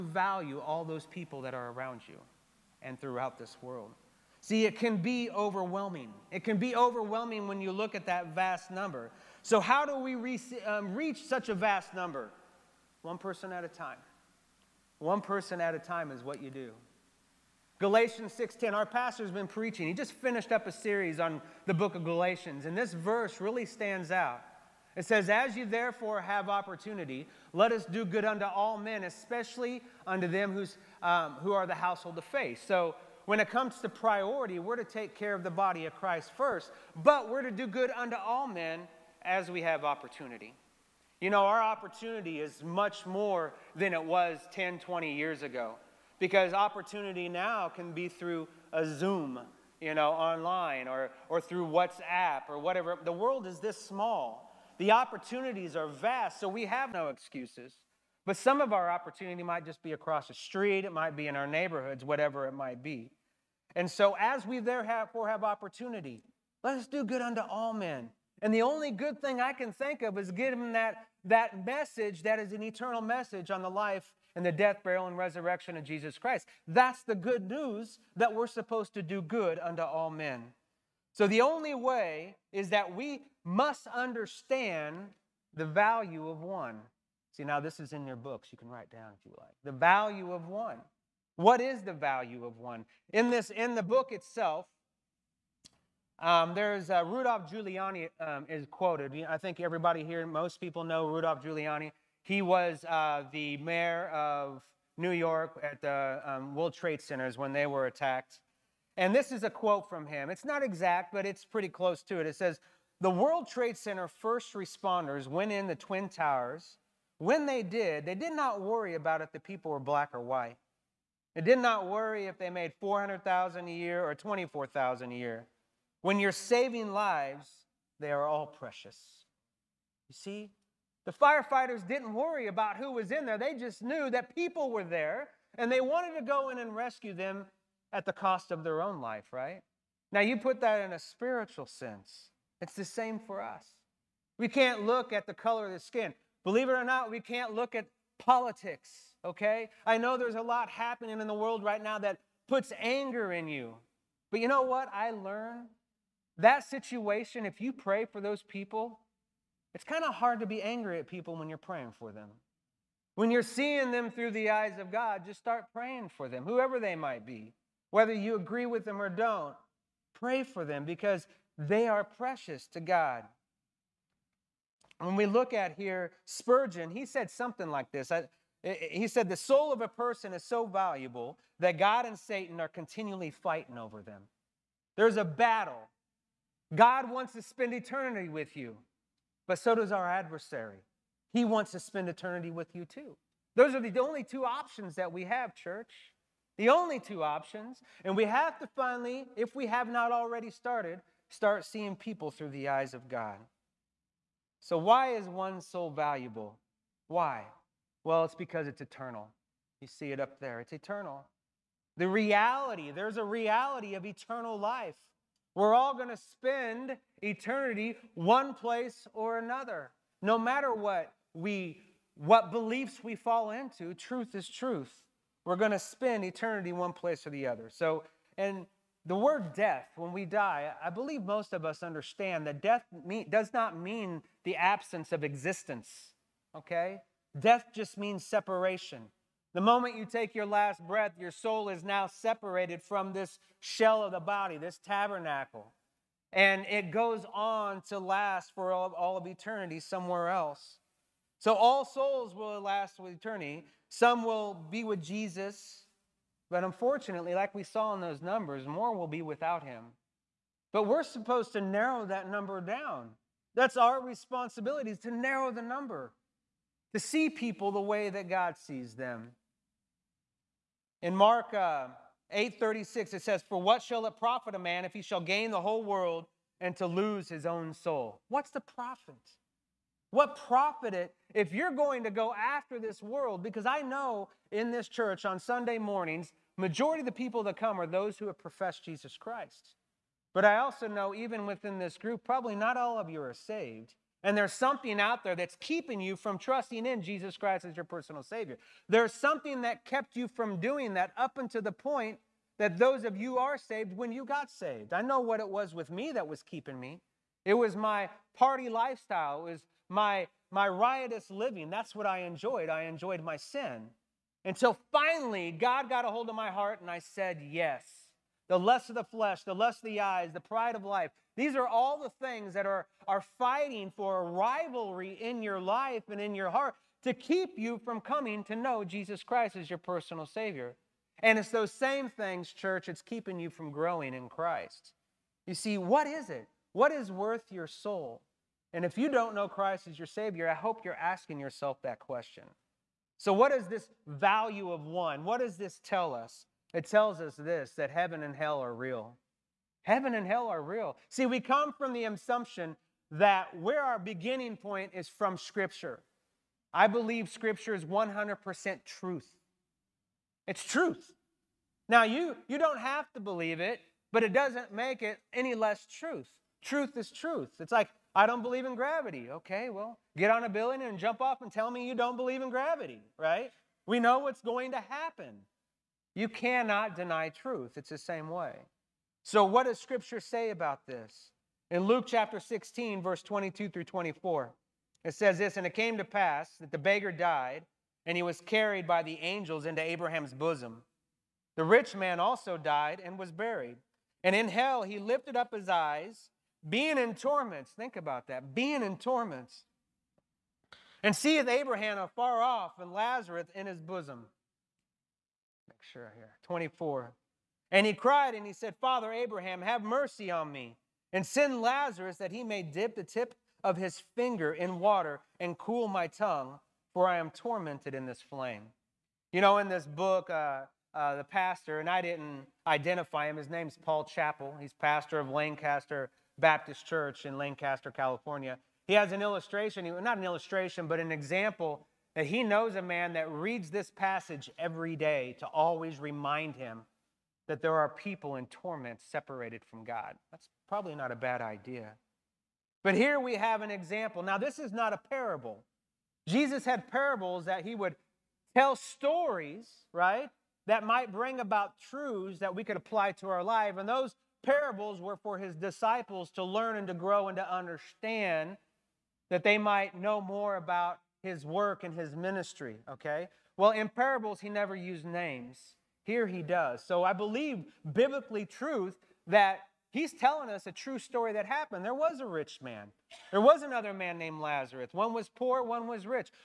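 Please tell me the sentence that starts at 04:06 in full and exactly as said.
And it goes on to last for all, all of eternity somewhere else.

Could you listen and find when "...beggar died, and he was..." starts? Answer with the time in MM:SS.
06:26.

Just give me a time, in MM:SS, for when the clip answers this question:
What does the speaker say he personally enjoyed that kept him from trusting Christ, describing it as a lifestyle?
05:08.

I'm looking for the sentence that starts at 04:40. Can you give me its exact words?
What profit it if you're going to go after this world?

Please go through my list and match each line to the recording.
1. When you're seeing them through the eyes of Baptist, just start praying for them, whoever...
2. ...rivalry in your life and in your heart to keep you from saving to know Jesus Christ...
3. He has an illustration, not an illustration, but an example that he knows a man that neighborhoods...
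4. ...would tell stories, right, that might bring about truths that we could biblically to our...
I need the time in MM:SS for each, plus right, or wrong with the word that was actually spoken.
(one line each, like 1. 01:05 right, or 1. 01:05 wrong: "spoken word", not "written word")
1. 02:43 wrong: "God", not "Baptist"
2. 05:24 wrong: "coming", not "saving"
3. 07:08 wrong: "reads", not "neighborhoods"
4. 07:27 wrong: "apply", not "biblically".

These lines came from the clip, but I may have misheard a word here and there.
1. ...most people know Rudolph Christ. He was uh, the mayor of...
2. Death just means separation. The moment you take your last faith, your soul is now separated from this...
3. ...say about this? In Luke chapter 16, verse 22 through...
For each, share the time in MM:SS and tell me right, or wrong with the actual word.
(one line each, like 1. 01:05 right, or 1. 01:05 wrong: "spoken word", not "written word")
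1. 01:40 wrong: "Giuliani", not "Christ"
2. 03:57 wrong: "breath", not "faith"
3. 06:20 right.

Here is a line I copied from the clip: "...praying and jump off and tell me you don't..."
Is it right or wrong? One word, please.
wrong.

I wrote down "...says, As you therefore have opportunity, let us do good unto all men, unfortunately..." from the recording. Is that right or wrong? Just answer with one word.
wrong.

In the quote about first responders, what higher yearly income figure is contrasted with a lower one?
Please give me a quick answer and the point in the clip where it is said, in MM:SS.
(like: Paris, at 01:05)
400,000, at 02:02.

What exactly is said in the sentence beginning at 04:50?
But I also know, even within this group, probably not all of you are saved.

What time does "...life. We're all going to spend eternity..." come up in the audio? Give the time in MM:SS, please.
03:34.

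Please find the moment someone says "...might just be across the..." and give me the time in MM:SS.
00:59.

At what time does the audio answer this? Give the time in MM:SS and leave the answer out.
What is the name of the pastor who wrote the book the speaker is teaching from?
07:03.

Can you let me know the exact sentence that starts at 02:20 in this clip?
Now, you put that in a spiritual sense.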